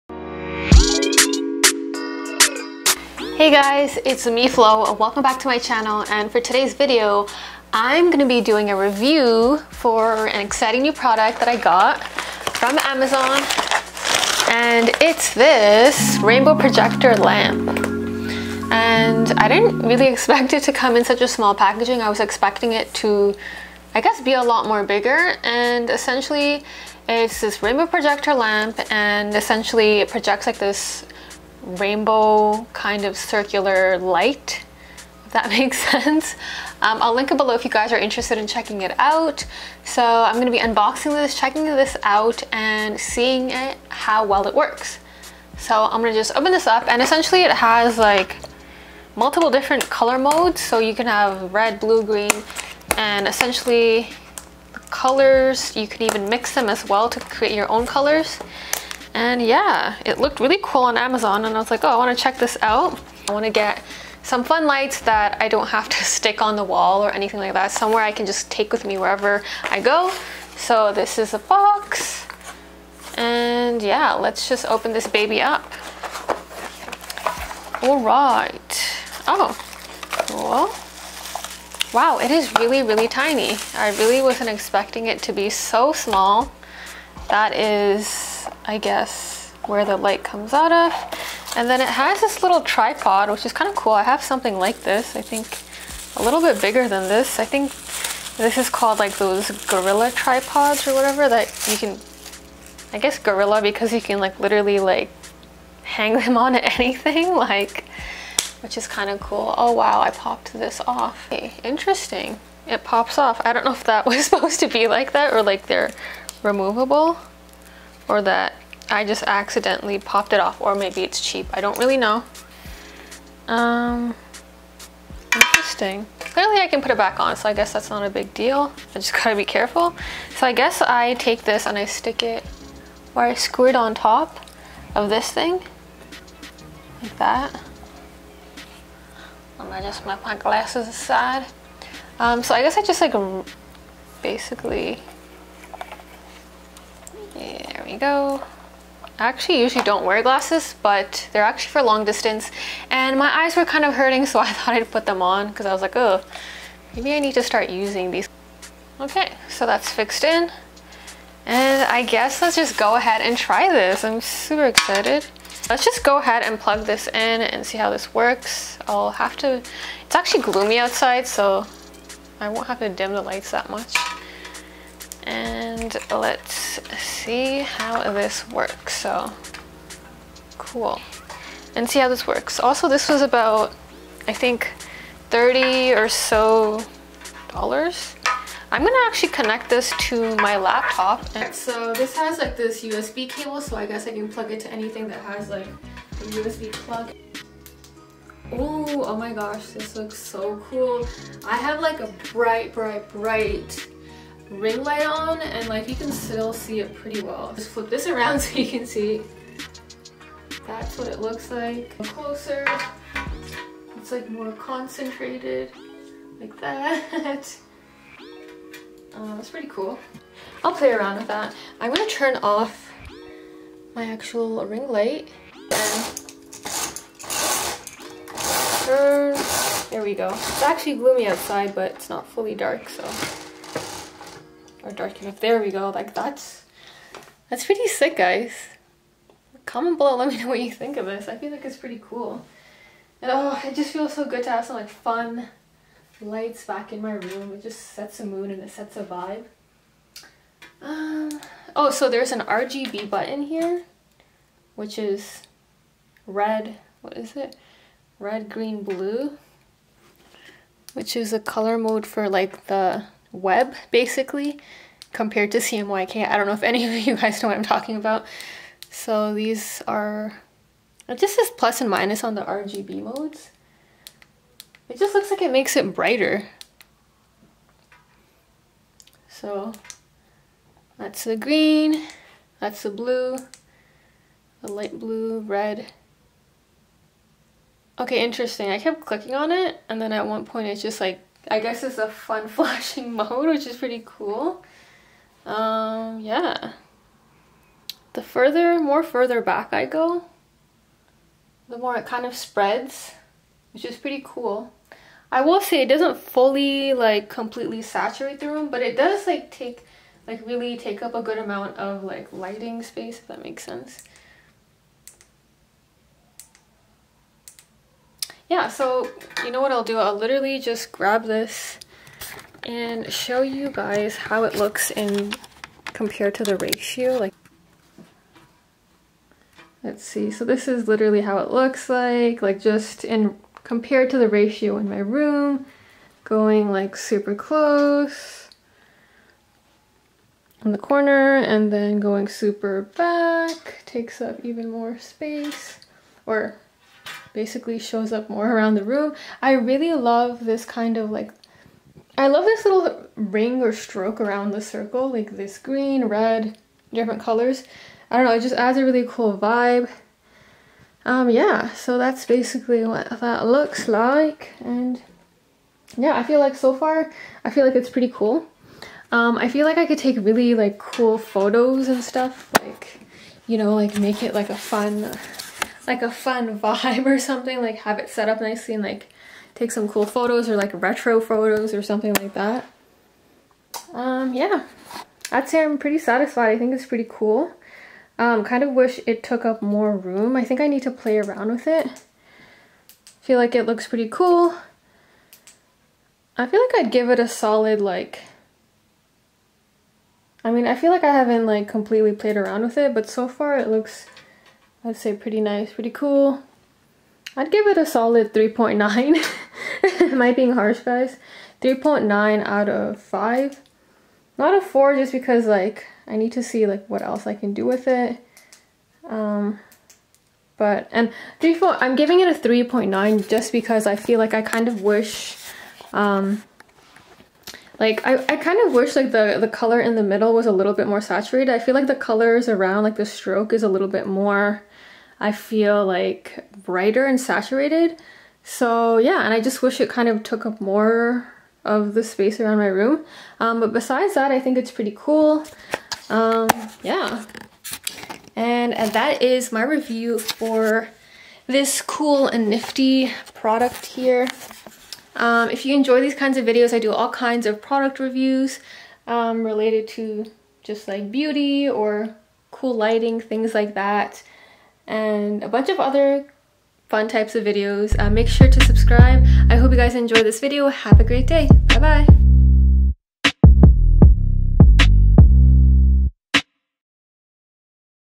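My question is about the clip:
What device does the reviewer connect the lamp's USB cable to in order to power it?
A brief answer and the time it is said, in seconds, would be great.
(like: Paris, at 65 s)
Laptop, at 190 s.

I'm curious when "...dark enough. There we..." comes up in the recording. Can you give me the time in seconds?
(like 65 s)
234 s.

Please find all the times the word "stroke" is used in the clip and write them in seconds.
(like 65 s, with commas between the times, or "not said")
353 s, 433 s.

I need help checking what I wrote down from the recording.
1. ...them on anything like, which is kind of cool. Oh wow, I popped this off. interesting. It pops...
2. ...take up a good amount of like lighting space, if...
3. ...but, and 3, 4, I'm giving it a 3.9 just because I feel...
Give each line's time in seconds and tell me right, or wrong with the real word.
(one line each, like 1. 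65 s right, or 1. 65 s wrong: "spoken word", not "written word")
1. 106 s right
2. 310 s right
3. 420 s right.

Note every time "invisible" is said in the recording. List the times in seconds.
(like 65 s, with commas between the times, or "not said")
not said.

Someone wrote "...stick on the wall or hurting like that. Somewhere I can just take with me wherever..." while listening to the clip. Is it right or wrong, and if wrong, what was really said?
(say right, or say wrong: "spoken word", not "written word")
wrong: "anything", not "hurting".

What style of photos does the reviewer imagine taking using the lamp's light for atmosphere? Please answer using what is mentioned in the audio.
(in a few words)
Retro photos.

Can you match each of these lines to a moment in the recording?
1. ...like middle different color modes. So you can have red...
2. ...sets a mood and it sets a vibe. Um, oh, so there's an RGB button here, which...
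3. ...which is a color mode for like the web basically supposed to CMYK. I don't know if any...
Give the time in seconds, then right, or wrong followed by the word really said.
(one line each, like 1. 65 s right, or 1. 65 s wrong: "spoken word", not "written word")
1. 47 s wrong: "multiple", not "middle"
2. 247 s right
3. 260 s wrong: "compared", not "supposed".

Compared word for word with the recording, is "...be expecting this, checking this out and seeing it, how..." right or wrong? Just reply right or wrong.
wrong.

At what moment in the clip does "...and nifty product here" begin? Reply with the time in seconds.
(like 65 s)
452 s.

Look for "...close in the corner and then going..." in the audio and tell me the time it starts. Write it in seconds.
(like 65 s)
337 s.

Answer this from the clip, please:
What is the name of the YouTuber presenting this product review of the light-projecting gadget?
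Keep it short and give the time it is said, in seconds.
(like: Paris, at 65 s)
Flo, at 4 s.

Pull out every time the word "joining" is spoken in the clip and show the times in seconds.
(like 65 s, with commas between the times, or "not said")
not said.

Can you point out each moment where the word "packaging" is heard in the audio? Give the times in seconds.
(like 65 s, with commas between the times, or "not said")
21 s.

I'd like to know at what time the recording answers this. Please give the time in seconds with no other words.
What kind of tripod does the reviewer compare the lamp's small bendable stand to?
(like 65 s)
99 s.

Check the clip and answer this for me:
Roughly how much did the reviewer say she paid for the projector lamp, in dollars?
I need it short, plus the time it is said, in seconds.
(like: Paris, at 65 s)
30, at 185 s.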